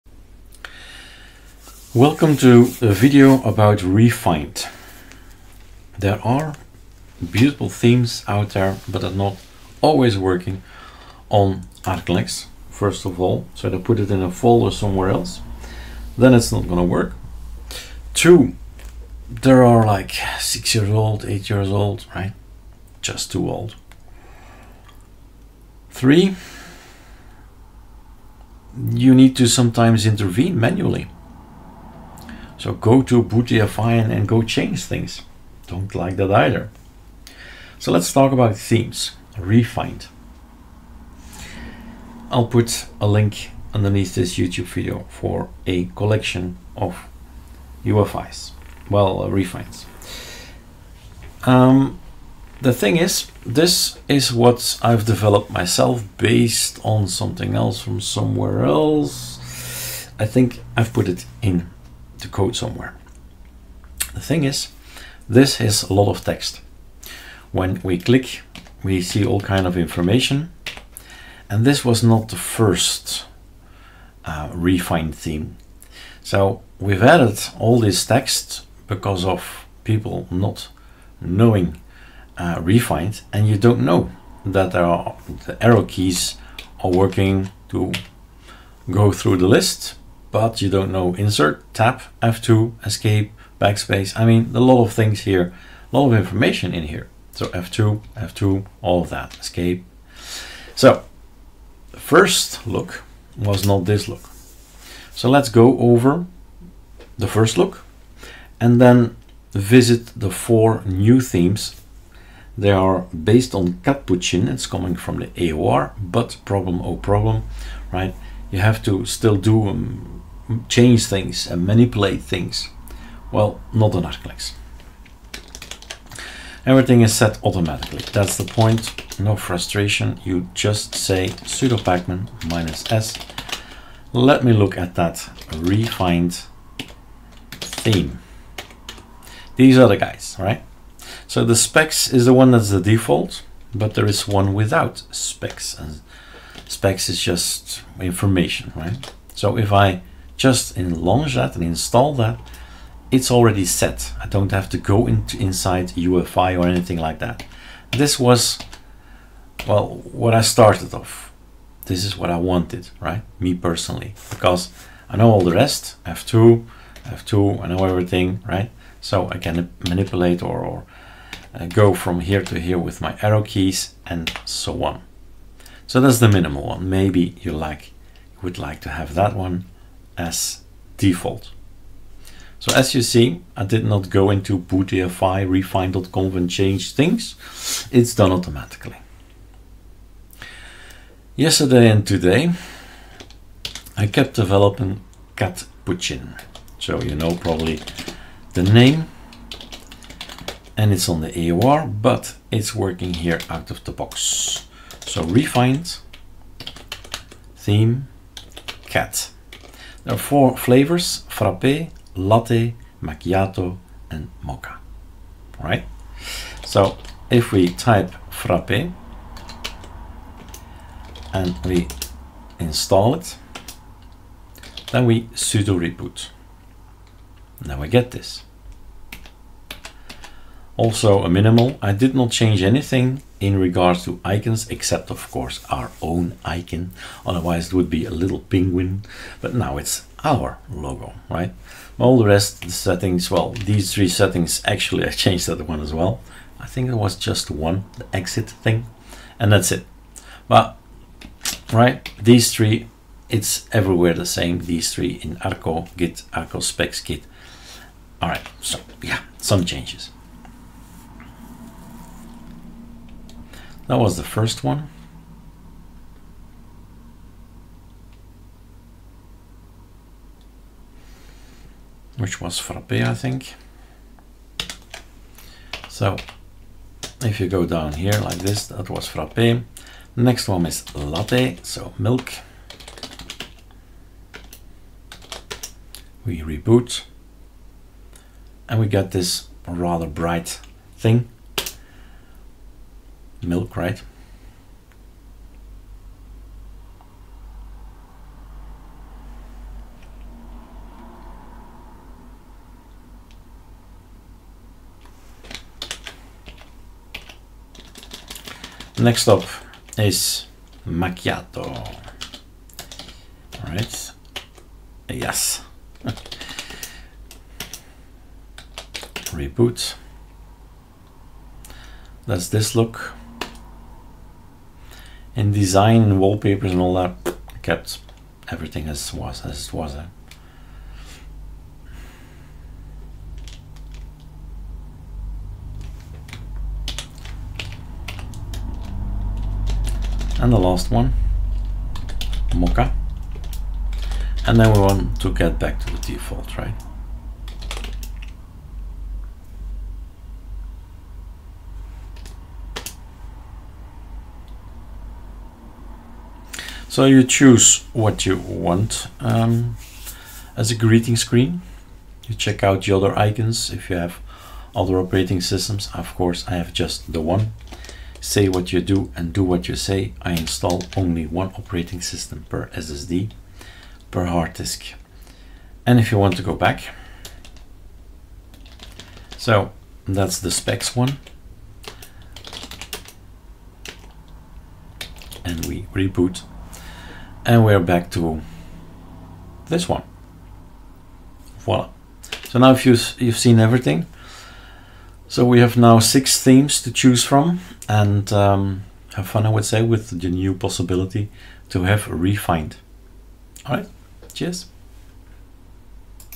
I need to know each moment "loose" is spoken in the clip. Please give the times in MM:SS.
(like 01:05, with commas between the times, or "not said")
not said.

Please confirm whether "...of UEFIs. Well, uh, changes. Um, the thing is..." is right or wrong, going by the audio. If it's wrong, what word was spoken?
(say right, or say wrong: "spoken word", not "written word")
wrong: "refines", not "changes".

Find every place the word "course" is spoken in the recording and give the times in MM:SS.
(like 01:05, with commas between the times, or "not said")
03:55, 06:06.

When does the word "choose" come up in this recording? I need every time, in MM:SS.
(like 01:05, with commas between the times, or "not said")
05:57, 06:36.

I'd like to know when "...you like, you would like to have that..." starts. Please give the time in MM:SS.
02:57.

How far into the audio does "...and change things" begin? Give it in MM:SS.
03:06.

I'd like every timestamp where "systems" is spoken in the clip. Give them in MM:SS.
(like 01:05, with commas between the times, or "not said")
06:05, 06:12.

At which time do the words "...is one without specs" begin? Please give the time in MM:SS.
02:24.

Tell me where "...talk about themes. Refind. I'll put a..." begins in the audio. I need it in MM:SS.
00:38.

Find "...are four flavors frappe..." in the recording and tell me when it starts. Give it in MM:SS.
03:30.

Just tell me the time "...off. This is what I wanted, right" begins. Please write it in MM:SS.
02:40.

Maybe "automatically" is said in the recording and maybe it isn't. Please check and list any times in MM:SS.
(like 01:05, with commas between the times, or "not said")
02:07, 03:08.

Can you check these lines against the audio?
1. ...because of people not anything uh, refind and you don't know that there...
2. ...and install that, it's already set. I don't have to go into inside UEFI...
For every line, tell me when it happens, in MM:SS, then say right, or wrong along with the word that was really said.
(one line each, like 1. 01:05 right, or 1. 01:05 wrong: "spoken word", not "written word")
1. 01:18 wrong: "knowing", not "anything"
2. 02:31 right.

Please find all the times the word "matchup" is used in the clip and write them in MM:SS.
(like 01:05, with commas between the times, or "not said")
not said.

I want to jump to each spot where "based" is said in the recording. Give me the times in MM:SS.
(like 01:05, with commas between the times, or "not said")
00:56, 01:53.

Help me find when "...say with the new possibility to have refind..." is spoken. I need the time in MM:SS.
06:39.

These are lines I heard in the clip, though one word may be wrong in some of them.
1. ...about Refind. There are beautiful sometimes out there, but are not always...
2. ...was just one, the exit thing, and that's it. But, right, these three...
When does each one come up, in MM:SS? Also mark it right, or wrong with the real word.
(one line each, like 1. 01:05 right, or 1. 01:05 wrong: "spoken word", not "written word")
1. 00:03 wrong: "themes", not "sometimes"
2. 04:06 right.